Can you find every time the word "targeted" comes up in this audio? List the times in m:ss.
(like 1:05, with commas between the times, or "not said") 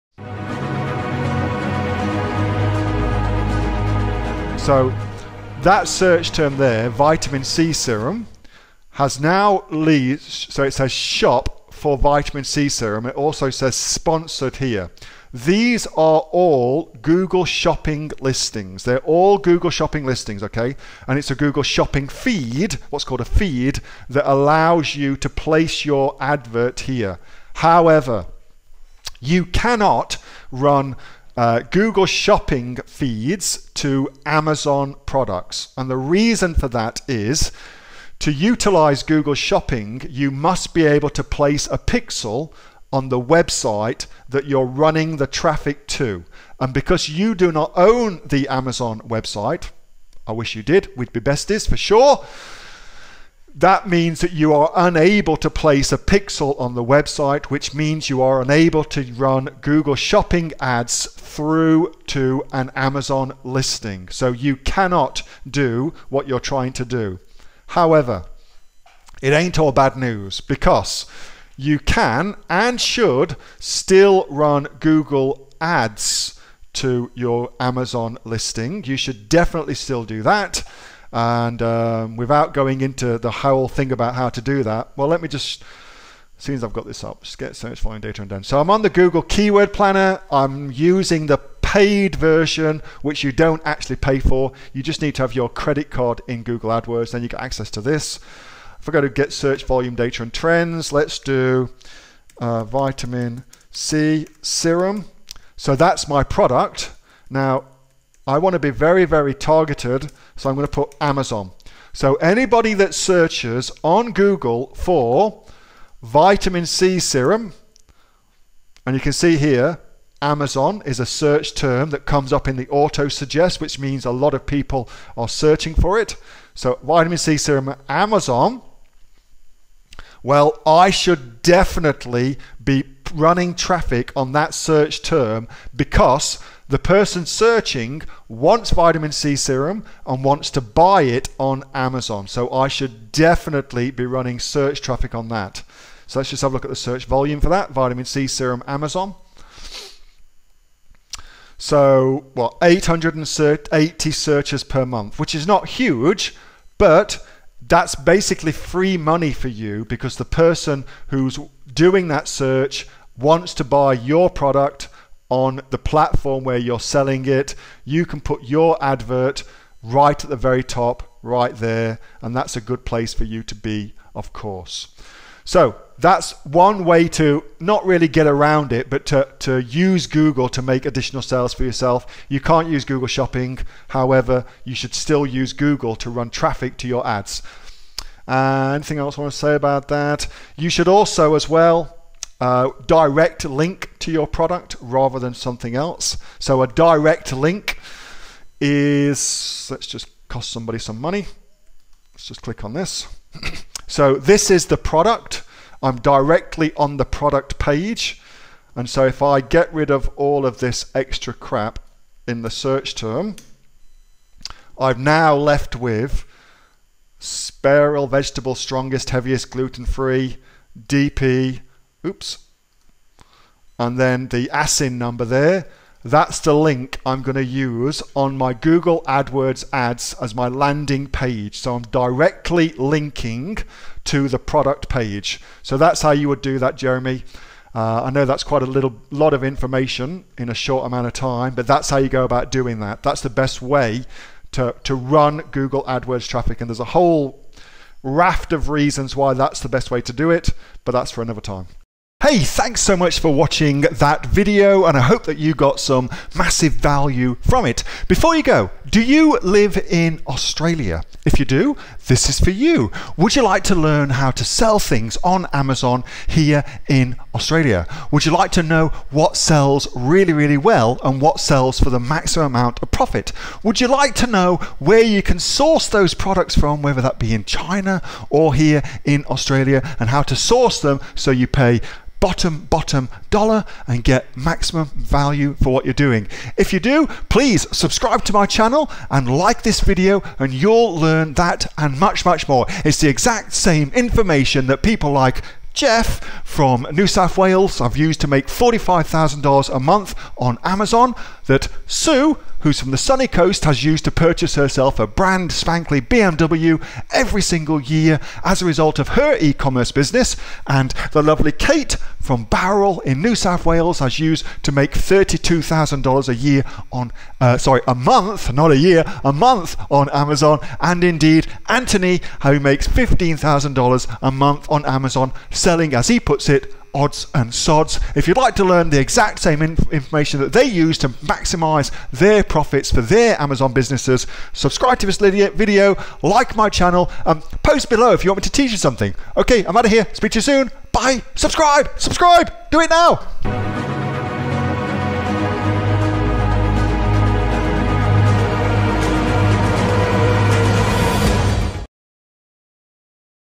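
1:49.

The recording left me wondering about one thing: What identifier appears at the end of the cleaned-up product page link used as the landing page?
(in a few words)
ASIN number.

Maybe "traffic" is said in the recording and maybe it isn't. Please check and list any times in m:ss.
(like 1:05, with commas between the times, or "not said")
0:45, 2:13, 2:24, 3:06, 4:06.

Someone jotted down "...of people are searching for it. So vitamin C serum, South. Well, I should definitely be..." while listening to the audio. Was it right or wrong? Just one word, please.
wrong.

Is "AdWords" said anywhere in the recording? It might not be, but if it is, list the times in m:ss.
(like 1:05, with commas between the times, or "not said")
1:36, 3:49, 4:05.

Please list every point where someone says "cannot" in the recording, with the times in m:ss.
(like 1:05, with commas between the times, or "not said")
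0:29, 1:04.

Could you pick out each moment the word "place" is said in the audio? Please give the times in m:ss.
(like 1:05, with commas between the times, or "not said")
0:25, 0:41, 0:55, 2:52.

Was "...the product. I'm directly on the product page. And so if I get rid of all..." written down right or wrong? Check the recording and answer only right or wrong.
right.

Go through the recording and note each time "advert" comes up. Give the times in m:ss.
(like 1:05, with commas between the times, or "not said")
0:26, 2:48.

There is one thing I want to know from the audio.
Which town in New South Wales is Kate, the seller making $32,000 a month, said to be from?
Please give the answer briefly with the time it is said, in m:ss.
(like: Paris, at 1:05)
Bowral, at 5:12.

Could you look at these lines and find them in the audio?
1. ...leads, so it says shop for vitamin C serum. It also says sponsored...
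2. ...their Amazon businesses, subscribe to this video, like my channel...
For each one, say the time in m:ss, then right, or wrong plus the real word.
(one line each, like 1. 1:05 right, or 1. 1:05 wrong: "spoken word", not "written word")
1. 0:09 right
2. 5:33 right.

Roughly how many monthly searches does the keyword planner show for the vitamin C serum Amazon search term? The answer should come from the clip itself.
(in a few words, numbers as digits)
880.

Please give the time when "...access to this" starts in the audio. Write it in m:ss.
1:37.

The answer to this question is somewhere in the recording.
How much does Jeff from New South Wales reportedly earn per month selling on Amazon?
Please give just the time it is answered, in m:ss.
4:58.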